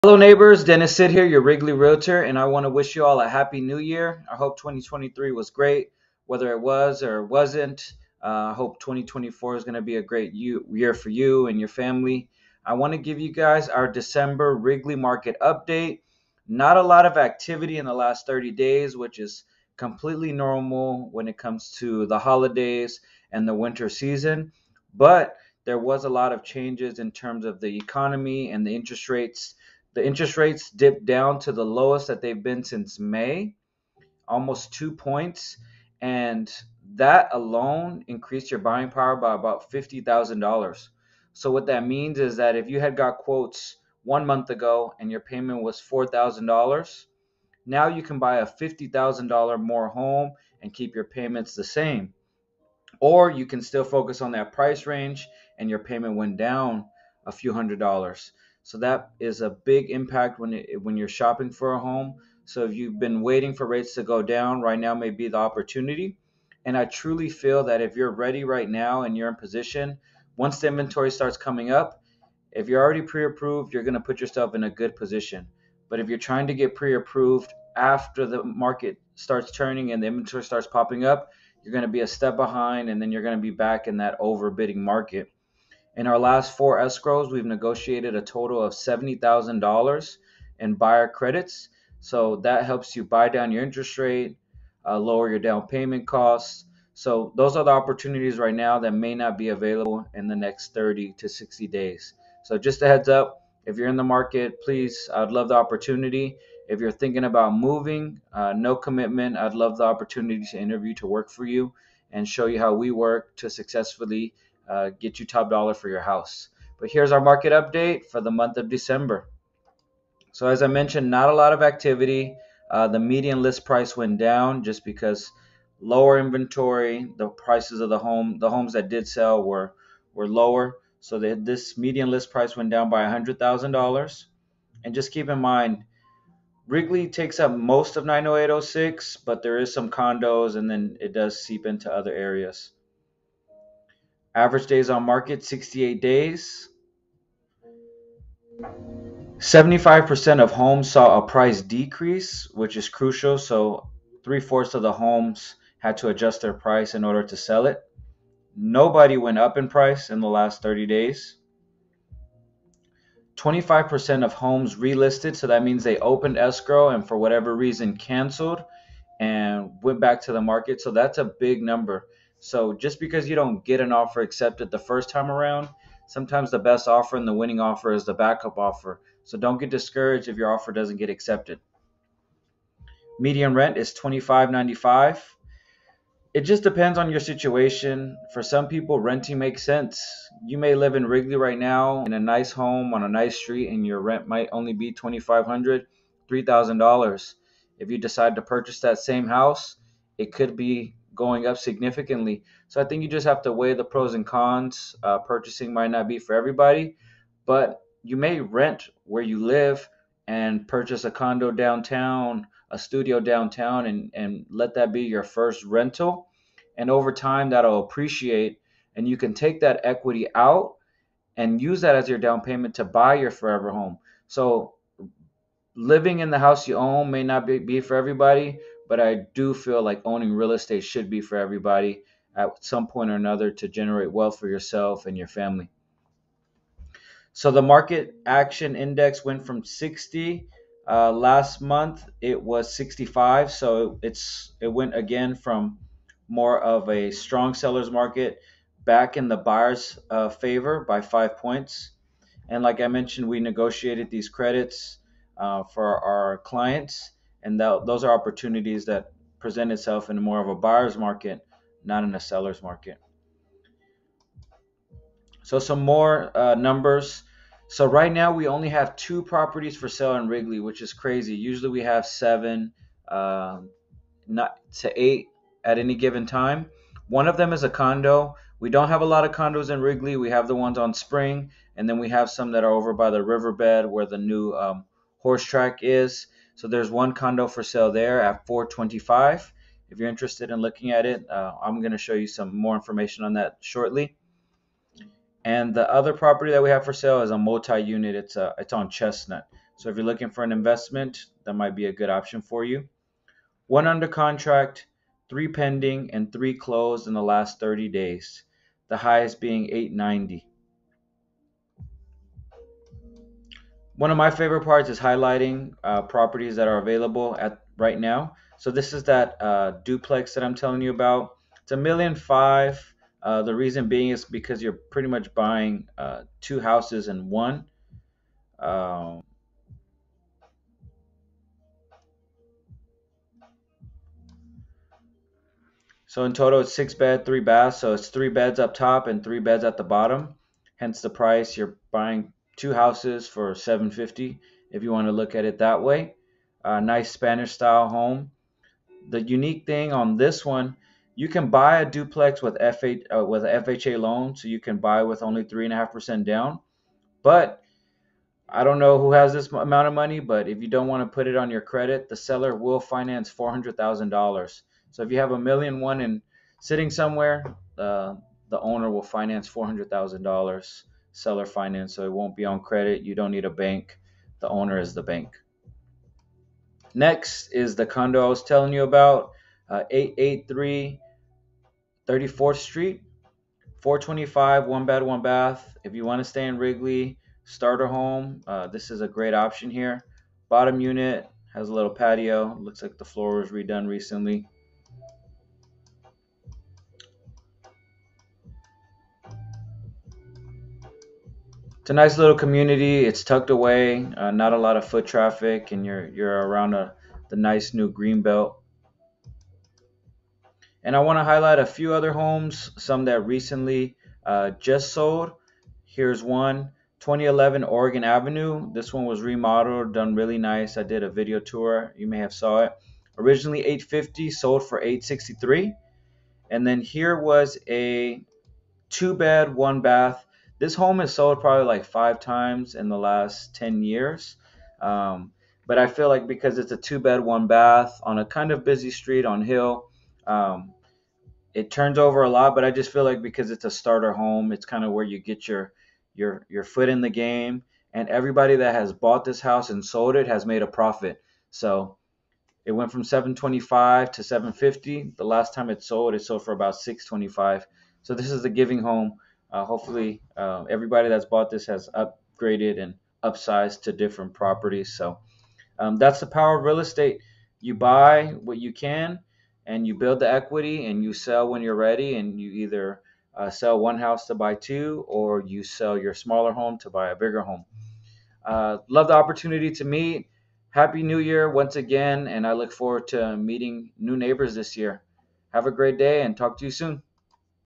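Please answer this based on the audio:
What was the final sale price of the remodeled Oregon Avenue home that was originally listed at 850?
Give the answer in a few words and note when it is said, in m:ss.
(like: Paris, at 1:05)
863, at 7:04.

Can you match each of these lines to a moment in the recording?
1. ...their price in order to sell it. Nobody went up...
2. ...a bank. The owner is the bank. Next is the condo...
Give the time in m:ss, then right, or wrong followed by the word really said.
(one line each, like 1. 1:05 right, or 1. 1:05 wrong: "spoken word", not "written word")
1. 2:36 right
2. 6:13 right.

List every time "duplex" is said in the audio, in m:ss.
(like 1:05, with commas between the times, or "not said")
5:19, 5:51.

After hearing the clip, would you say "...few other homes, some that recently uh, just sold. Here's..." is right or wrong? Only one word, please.
right.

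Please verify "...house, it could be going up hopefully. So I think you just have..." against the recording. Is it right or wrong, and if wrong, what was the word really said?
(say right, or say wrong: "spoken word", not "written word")
wrong: "significantly", not "hopefully".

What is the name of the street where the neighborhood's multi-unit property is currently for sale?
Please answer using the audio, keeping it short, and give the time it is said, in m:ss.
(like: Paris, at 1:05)
Chestnut, at 4:58.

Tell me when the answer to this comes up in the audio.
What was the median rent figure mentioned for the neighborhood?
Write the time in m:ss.
3:03.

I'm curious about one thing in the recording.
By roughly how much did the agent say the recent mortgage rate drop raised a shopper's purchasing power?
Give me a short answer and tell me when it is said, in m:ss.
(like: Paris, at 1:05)
$50,000, at 0:39.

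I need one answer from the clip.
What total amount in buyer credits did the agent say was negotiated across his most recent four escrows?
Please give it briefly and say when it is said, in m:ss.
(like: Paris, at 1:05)
$70,000, at 1:28.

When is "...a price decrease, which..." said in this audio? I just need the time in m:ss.
2:31.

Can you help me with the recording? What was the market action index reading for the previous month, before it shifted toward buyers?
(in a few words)
65.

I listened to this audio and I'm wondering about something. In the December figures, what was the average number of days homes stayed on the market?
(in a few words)
68 days.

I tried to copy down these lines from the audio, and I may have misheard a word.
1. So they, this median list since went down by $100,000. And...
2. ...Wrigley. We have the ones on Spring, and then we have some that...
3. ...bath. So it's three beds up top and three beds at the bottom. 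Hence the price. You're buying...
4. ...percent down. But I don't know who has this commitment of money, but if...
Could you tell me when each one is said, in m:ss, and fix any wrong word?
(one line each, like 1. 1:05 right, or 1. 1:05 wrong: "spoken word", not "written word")
1. 2:11 wrong: "price", not "since"
2. 4:39 right
3. 5:37 right
4. 5:55 wrong: "amount", not "commitment".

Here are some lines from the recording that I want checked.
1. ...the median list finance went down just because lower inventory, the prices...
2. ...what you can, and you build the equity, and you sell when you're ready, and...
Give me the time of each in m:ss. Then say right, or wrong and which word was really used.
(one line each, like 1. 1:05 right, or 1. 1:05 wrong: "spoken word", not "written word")
1. 2:02 wrong: "price", not "finance"
2. 7:48 right.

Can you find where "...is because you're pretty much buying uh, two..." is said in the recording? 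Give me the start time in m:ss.
5:24.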